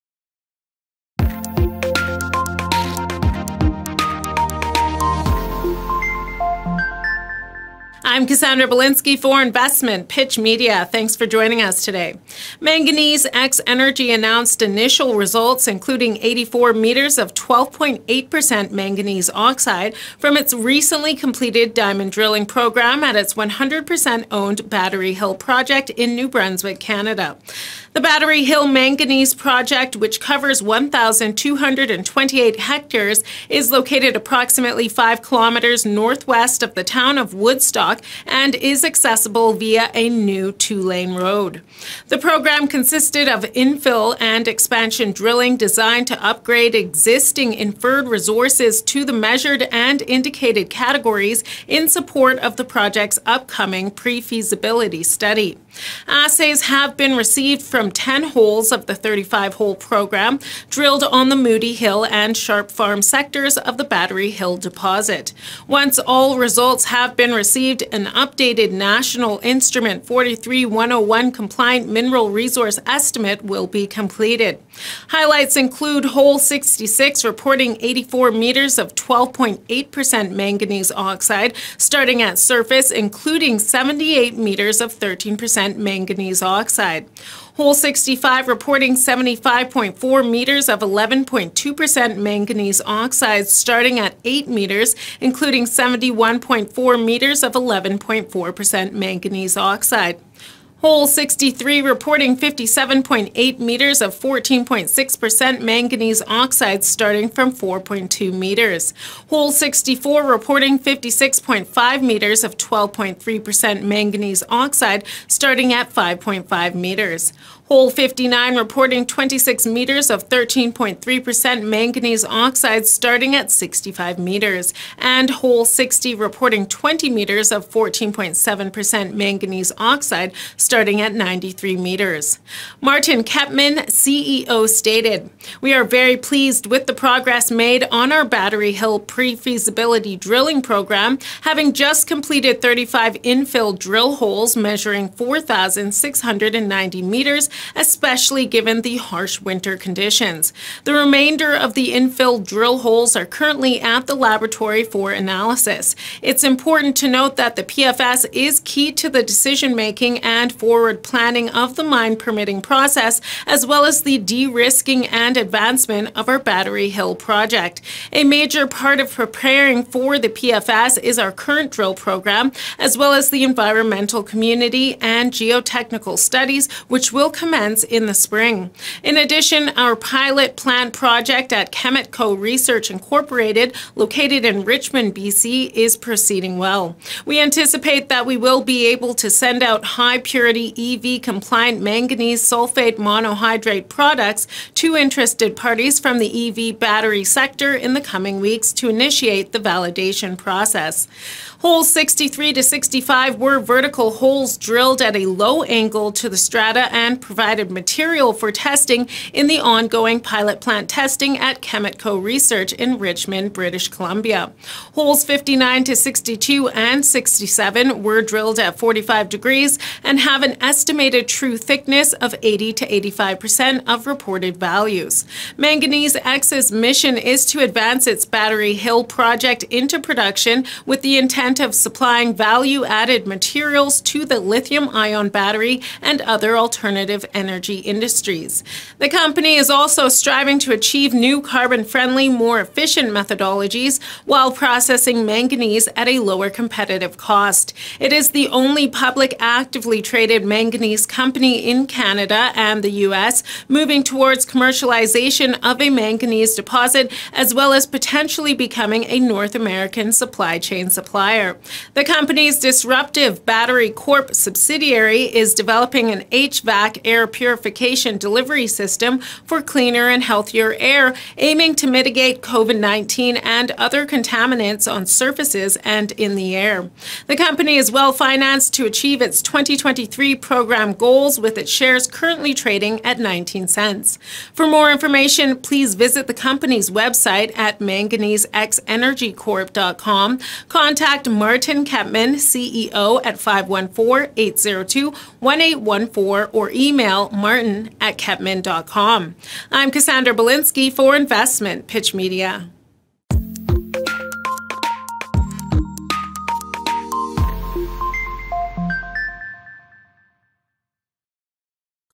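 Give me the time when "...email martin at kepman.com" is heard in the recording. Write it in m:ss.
4:56.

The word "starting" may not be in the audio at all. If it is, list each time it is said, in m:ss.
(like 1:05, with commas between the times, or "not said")
1:21, 1:33, 1:46, 1:55, 2:02, 2:10.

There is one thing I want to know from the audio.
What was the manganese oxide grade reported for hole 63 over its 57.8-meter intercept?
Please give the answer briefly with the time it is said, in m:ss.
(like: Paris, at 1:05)
14.6%, at 1:44.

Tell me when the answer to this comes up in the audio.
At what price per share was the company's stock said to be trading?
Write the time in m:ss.
4:43.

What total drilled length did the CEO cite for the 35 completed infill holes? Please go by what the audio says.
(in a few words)
4,690 meters.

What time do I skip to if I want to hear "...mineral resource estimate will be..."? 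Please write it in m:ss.
1:11.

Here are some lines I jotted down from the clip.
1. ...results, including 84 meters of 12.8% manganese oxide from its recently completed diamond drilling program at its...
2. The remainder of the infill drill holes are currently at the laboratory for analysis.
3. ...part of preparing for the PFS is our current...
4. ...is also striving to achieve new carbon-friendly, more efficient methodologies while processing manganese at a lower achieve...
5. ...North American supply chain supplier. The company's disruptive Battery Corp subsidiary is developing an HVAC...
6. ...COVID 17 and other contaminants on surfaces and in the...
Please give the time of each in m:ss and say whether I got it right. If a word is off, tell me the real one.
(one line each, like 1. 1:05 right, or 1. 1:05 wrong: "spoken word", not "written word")
1. 0:15 right
2. 2:30 right
3. 2:48 right
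4. 3:59 wrong: "competitive", not "achieve"
5. 4:19 right
6. 4:32 wrong: "19", not "17".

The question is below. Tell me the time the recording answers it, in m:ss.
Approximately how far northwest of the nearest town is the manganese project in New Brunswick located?
0:34.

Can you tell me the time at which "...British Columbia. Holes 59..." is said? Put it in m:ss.
3:33.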